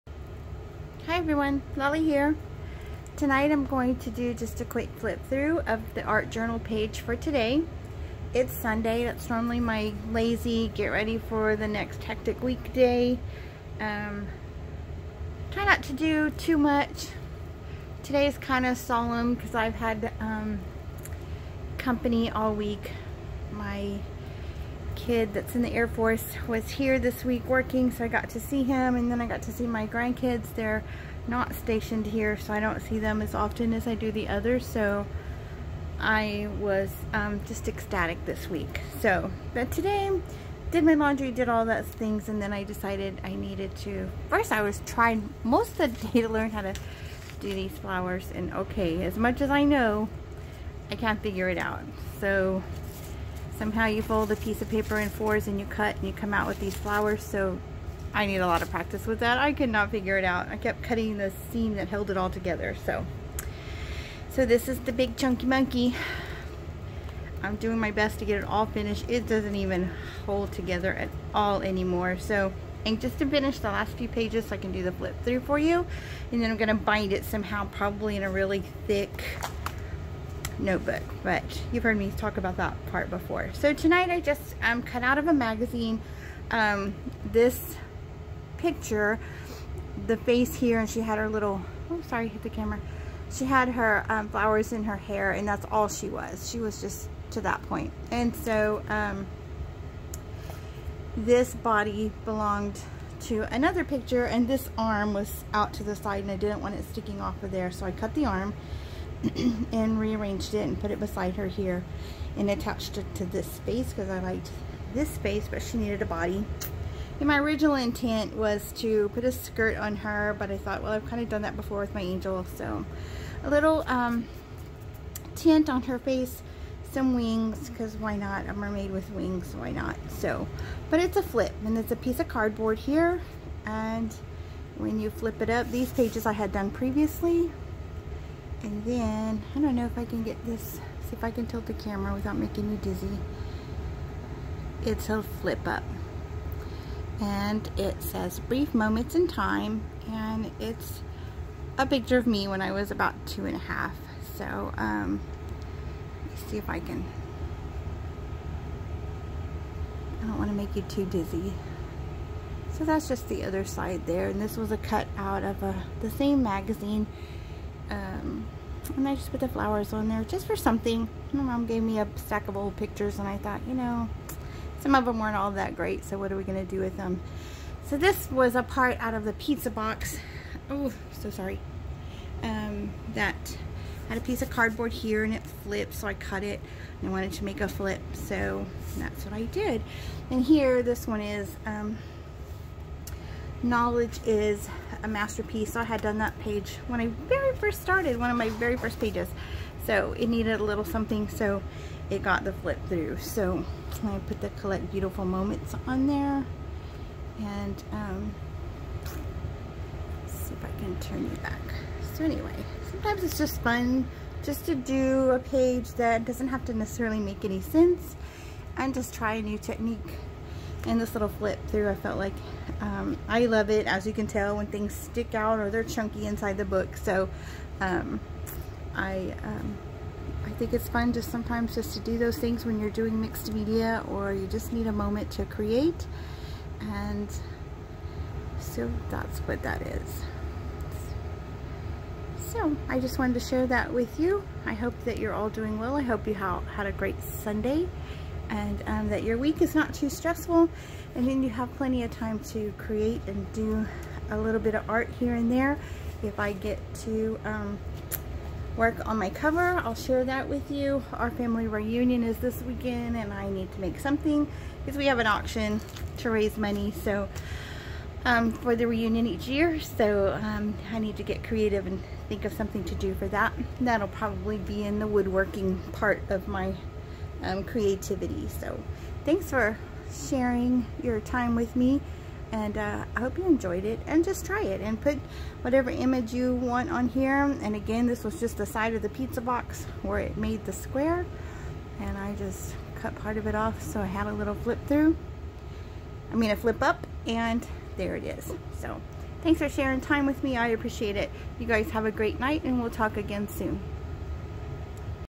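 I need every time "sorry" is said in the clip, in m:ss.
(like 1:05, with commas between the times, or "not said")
1:32, 3:01.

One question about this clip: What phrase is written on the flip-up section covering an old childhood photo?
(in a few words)
Brief moments in time.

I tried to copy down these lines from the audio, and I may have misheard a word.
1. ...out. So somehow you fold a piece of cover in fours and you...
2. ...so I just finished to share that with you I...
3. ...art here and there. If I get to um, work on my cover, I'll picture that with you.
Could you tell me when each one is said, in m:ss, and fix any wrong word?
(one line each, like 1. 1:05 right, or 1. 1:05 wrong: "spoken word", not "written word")
1. 0:51 wrong: "paper", not "cover"
2. 4:02 wrong: "wanted", not "finished"
3. 4:14 wrong: "share", not "picture".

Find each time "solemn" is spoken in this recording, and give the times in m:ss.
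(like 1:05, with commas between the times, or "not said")
0:18.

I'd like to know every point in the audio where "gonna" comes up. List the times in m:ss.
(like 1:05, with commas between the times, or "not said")
1:16, 2:56.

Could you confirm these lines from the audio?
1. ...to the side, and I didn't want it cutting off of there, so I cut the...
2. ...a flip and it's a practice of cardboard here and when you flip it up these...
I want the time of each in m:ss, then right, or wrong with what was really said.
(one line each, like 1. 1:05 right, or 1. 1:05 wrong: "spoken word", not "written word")
1. 1:45 wrong: "sticking", not "cutting"
2. 2:11 wrong: "piece", not "practice".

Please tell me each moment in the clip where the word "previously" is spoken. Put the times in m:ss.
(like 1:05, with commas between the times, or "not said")
2:16.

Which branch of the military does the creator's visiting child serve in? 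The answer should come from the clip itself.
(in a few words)
Air Force.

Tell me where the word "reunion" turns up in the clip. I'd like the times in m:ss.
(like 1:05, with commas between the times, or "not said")
4:21, 4:28.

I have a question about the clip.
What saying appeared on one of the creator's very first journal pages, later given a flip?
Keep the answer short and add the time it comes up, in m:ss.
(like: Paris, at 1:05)
Knowledge is a masterpiece, at 3:13.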